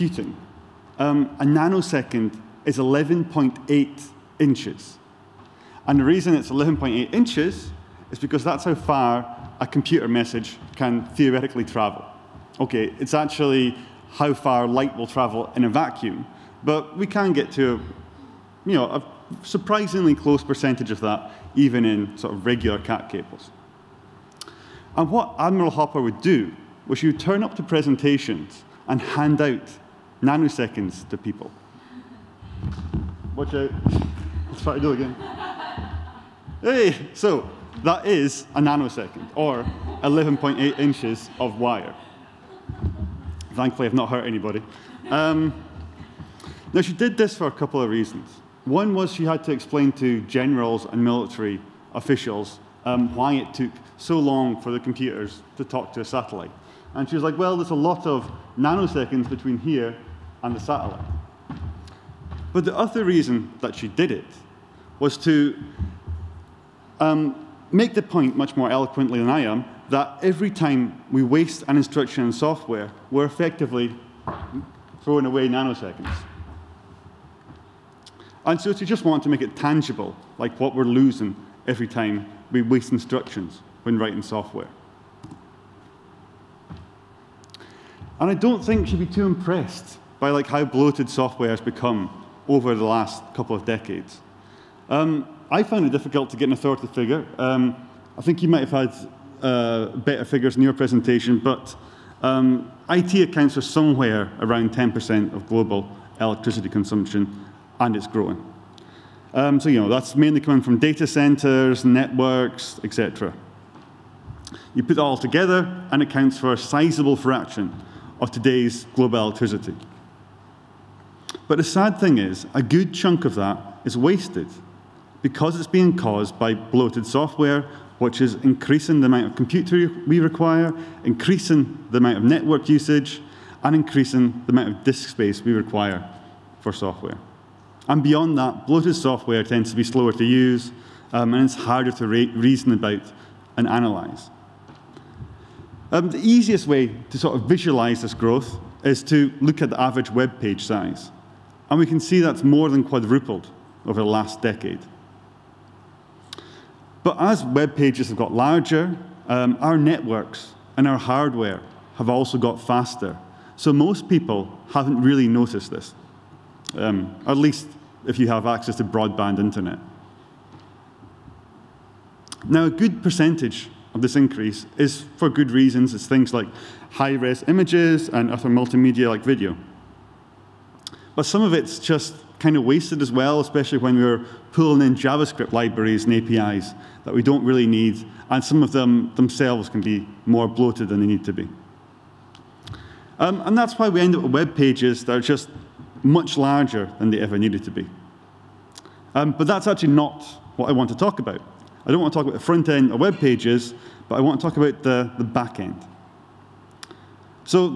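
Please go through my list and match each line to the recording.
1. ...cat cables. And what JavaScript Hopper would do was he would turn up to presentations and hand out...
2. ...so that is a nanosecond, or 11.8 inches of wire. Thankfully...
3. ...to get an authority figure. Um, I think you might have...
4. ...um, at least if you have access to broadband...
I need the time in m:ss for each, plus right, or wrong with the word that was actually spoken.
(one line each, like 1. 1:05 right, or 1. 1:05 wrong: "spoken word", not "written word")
1. 0:22 wrong: "Admiral", not "JavaScript"
2. 0:37 right
3. 1:36 right
4. 2:46 right.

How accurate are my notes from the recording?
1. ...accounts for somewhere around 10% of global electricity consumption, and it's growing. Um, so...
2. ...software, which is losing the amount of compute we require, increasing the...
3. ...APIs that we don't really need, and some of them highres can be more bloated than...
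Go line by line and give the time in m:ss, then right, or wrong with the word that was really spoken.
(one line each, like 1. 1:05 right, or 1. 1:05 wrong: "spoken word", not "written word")
1. 1:43 right
2. 2:07 wrong: "increasing", not "losing"
3. 3:06 wrong: "themselves", not "highres".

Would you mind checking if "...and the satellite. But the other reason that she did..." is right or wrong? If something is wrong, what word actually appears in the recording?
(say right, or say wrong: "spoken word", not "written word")
right.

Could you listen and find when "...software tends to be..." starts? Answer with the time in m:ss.
2:18.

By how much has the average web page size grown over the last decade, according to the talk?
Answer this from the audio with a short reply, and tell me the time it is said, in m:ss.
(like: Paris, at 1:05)
more than quadrupled, at 2:32.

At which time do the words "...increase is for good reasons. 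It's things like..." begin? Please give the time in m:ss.
2:54.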